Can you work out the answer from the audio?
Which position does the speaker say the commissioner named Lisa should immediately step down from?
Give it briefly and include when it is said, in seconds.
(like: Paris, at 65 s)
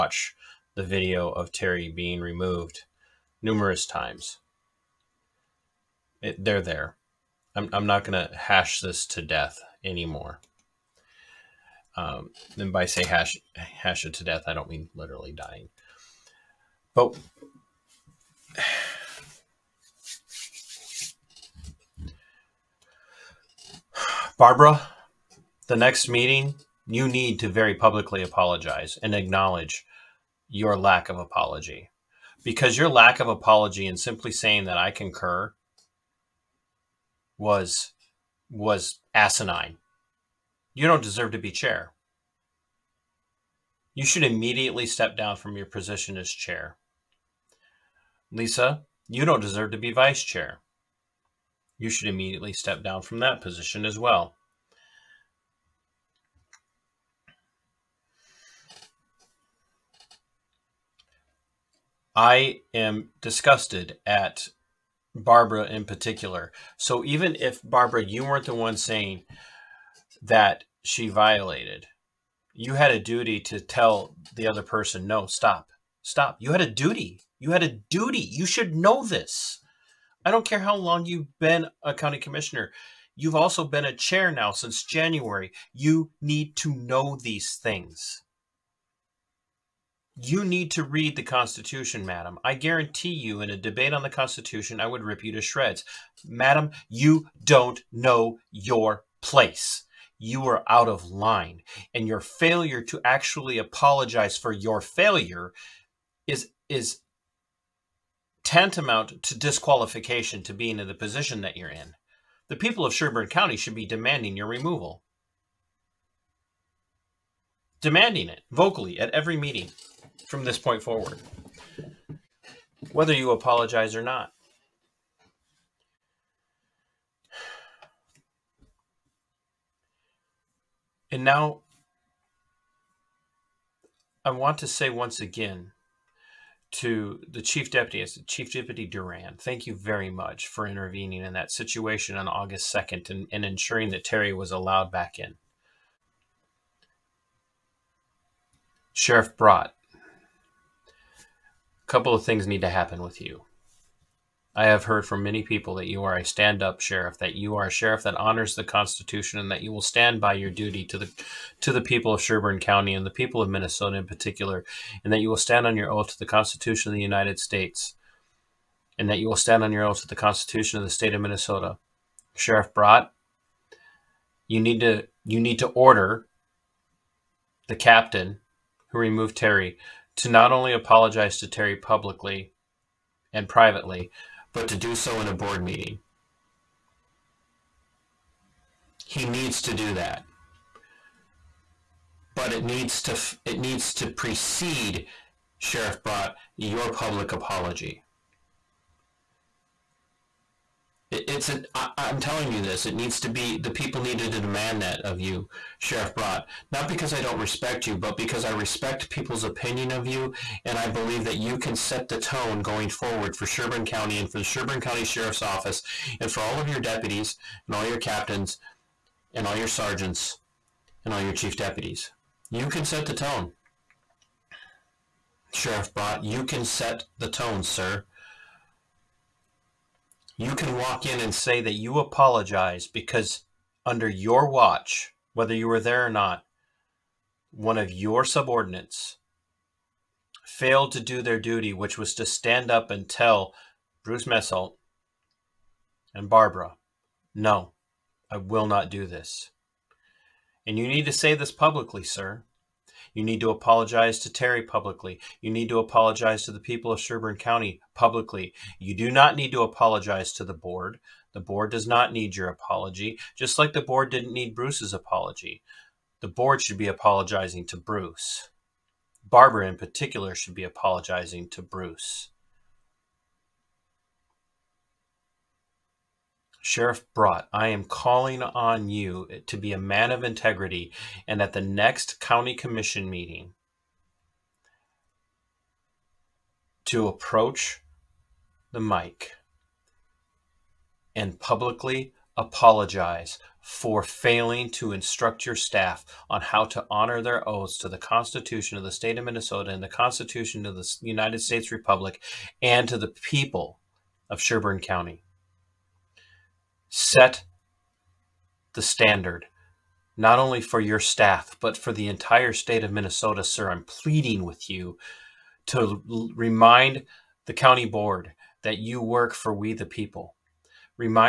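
Vice chair, at 49 s.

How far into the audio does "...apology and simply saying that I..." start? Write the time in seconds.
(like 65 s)
33 s.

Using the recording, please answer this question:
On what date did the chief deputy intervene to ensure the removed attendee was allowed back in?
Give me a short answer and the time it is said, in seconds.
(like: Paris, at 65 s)
August 2, at 142 s.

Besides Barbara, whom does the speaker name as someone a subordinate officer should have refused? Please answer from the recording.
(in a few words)
Bruce Messelt.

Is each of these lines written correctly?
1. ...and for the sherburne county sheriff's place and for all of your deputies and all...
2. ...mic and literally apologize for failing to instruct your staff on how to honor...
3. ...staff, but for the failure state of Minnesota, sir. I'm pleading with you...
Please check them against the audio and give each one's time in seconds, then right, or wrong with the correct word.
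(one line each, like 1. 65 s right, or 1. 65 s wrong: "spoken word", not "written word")
1. 214 s wrong: "office", not "place"
2. 288 s wrong: "publicly", not "literally"
3. 310 s wrong: "entire", not "failure".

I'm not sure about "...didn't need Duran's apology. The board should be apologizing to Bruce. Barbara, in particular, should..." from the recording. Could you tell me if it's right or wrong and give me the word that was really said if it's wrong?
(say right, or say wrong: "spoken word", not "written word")
wrong: "Bruce", not "Duran".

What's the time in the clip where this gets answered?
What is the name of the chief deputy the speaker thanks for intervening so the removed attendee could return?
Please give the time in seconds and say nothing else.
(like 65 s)
138 s.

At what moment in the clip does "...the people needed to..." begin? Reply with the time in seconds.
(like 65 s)
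203 s.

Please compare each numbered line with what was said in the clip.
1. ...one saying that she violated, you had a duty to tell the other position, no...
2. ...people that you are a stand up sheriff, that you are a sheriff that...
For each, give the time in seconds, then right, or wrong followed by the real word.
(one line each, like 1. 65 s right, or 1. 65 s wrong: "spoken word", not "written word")
1. 68 s wrong: "person", not "position"
2. 155 s right.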